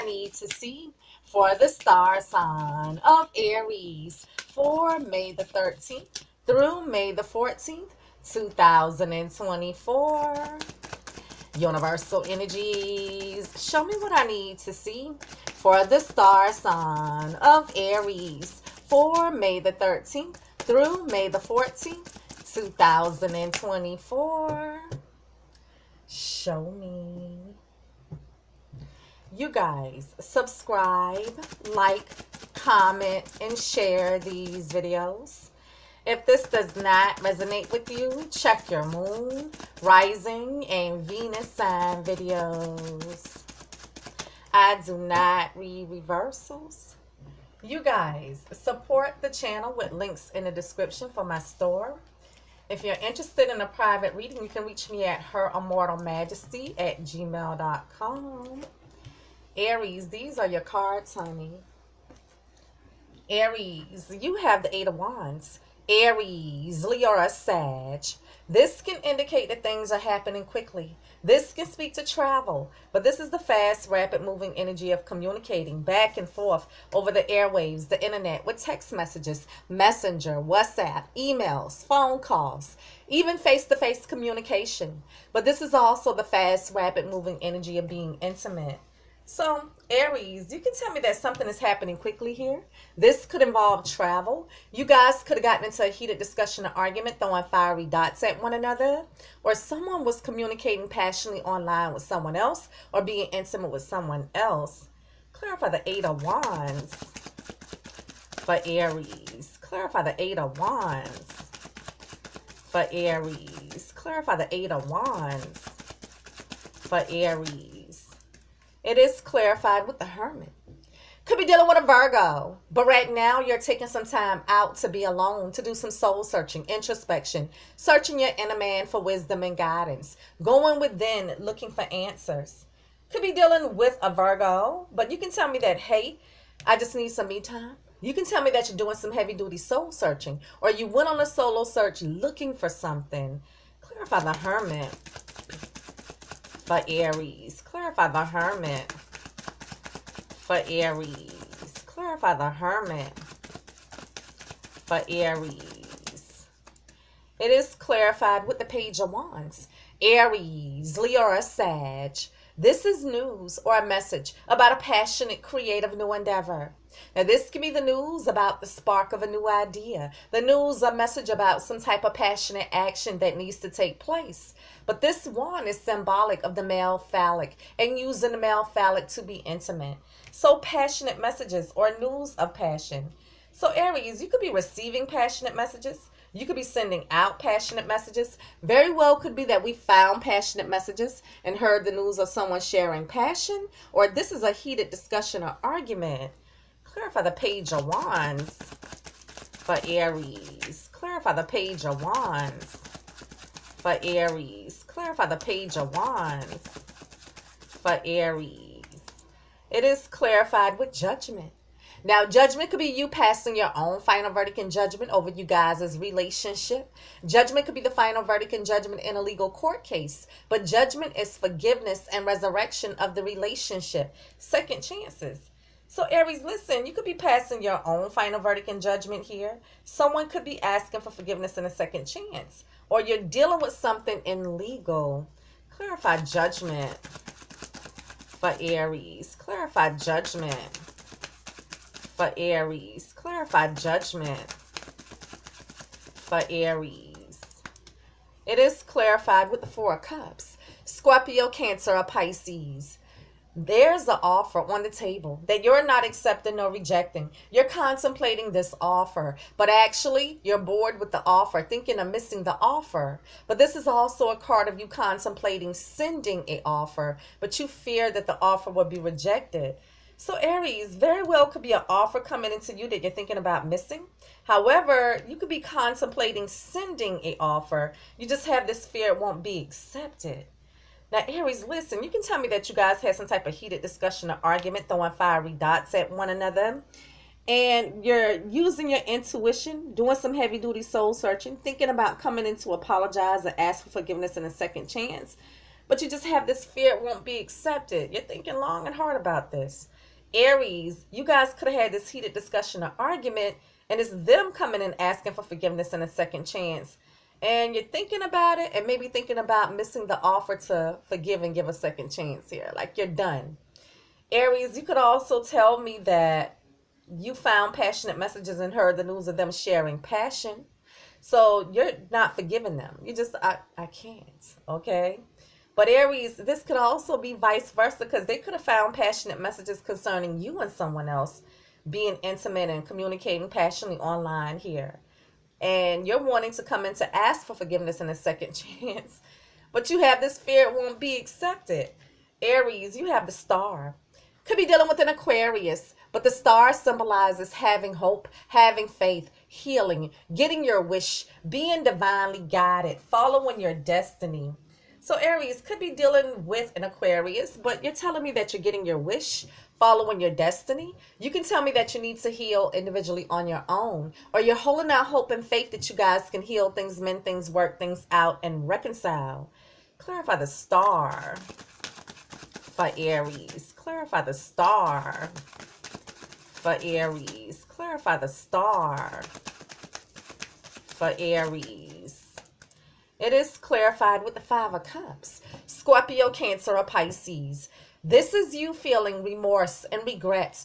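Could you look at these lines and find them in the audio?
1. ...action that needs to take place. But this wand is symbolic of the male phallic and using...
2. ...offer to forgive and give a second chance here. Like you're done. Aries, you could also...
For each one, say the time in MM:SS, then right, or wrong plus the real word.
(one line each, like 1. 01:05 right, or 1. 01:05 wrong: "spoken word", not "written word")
1. 02:52 right
2. 05:10 right.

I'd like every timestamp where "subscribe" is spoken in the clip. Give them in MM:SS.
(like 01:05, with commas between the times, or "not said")
00:30.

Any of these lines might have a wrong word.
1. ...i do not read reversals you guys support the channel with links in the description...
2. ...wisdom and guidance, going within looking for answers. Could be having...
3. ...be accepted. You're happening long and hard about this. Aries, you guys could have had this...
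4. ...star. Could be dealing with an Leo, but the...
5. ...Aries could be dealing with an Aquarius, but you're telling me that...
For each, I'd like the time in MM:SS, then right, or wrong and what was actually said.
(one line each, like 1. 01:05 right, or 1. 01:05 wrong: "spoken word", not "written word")
1. 00:44 right
2. 02:09 wrong: "dealing", not "having"
3. 04:57 wrong: "thinking", not "happening"
4. 05:43 wrong: "Aquarius", not "Leo"
5. 05:55 right.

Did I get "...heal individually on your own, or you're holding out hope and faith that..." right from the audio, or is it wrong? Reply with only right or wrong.
right.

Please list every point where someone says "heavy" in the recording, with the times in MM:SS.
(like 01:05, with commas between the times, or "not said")
02:19, 04:50.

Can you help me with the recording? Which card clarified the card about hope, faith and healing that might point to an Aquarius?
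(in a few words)
Five of Cups.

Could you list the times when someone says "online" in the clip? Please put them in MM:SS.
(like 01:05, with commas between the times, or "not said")
01:41, 05:33.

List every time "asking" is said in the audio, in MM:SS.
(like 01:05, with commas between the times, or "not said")
03:50, 05:04.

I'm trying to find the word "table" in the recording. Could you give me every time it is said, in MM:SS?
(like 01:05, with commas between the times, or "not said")
04:14.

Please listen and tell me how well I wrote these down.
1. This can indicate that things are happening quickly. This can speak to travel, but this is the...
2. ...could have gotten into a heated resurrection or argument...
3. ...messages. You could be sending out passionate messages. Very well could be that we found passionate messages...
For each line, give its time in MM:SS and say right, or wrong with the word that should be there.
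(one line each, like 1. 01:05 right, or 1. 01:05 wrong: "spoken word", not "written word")
1. 01:08 right
2. 01:35 wrong: "discussion", not "resurrection"
3. 03:05 right.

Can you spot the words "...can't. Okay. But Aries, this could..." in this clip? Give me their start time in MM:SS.
05:23.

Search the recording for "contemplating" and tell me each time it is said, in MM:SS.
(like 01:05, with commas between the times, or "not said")
04:17, 04:24, 04:35.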